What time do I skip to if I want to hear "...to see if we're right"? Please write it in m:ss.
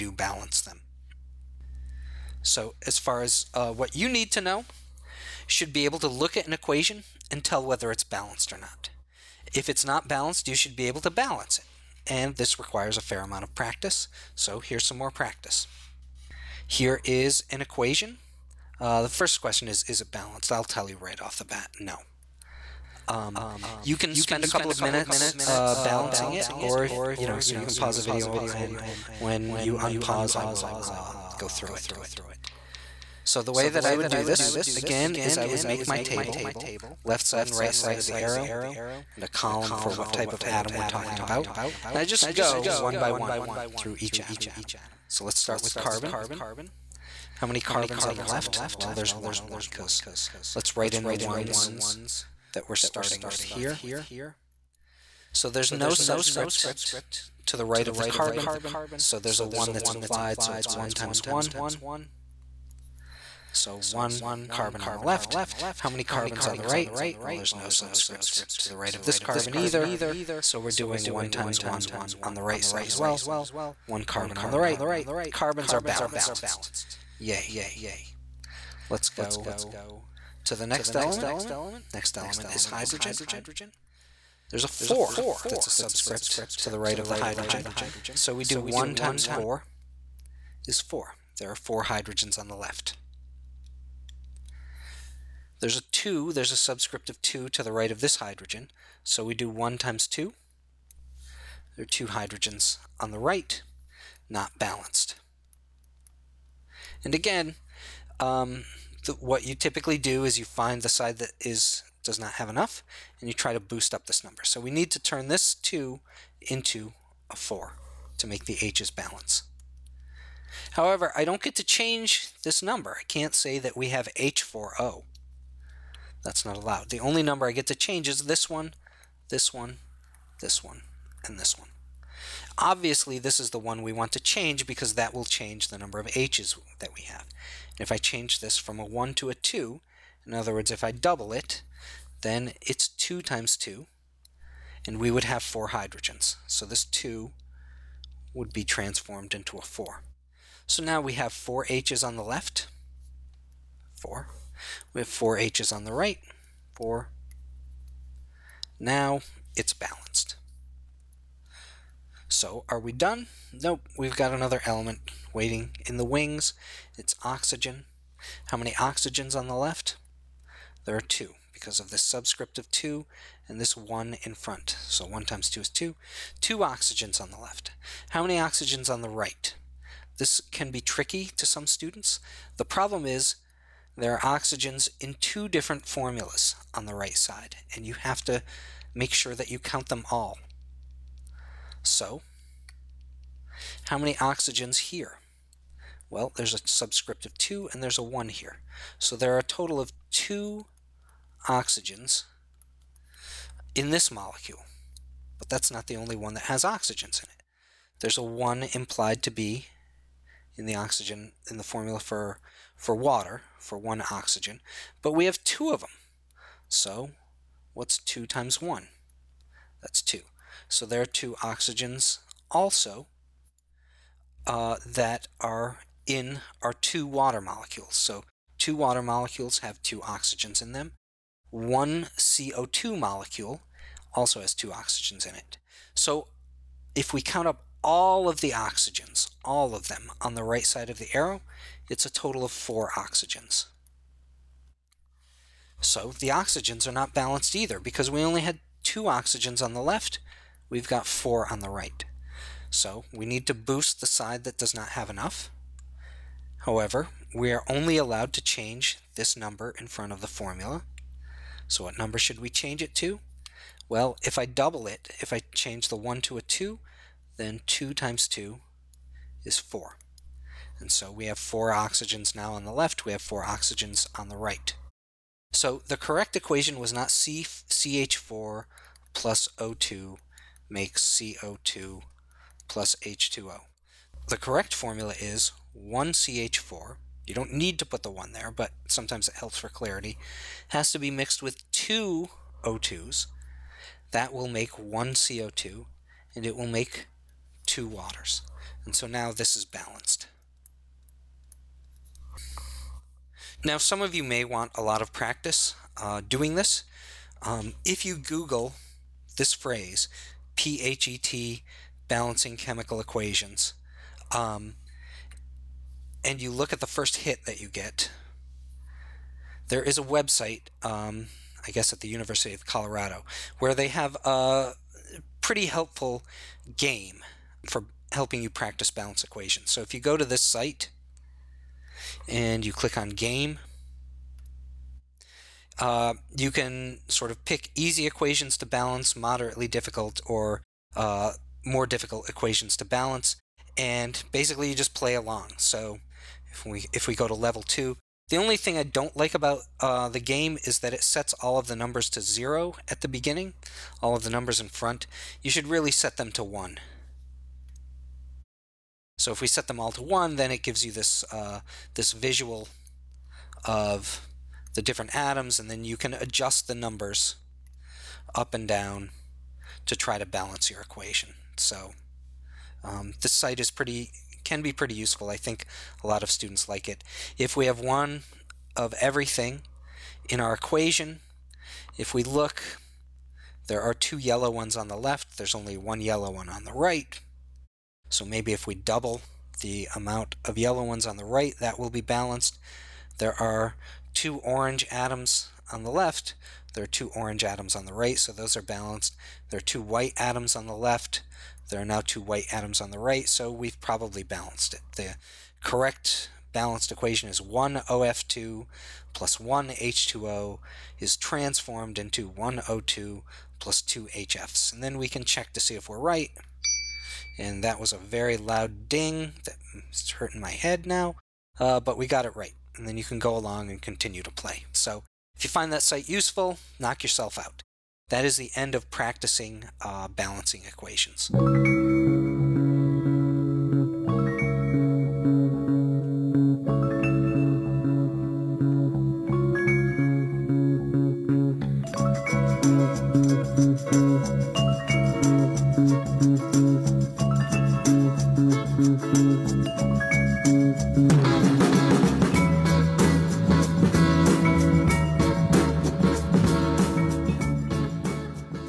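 6:55.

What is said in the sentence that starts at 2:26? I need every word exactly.
So this 2 would be transformed into a 4.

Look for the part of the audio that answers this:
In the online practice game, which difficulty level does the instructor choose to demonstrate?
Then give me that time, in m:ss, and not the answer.
5:47.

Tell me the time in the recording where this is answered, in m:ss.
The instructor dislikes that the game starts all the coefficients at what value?
5:52.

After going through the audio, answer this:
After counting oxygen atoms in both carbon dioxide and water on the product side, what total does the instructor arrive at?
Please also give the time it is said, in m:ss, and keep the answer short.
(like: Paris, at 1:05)
4, at 4:02.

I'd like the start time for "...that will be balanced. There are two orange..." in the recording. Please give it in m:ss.
6:31.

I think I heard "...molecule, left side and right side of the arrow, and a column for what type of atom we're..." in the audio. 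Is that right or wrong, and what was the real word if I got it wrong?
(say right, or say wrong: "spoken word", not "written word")
wrong: "table", not "molecule".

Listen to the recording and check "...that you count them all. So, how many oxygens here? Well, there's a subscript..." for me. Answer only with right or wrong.
right.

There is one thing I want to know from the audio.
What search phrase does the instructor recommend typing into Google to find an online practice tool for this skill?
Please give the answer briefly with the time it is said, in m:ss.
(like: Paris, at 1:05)
PHET balancing chemical equations, at 5:10.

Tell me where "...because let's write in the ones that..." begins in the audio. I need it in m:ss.
0:49.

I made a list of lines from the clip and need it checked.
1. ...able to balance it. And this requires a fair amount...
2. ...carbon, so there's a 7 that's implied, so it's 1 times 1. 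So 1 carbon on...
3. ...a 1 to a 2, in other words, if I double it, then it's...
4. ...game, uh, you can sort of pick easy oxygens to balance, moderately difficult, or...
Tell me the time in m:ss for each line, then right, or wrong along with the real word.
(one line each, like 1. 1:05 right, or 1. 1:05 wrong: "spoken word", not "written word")
1. 0:10 right
2. 0:58 wrong: "1", not "7"
3. 2:18 right
4. 5:33 wrong: "equations", not "oxygens".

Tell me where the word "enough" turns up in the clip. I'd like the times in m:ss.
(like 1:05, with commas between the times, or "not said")
1:52, 4:15.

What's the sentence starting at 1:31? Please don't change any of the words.
There are 4 hydrogens on the left.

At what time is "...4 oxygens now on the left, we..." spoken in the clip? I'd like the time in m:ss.
4:31.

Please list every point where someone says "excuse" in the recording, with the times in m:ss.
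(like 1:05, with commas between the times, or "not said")
not said.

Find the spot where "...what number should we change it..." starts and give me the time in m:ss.
4:21.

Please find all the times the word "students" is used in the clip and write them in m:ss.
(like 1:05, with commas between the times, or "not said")
3:01, 6:16.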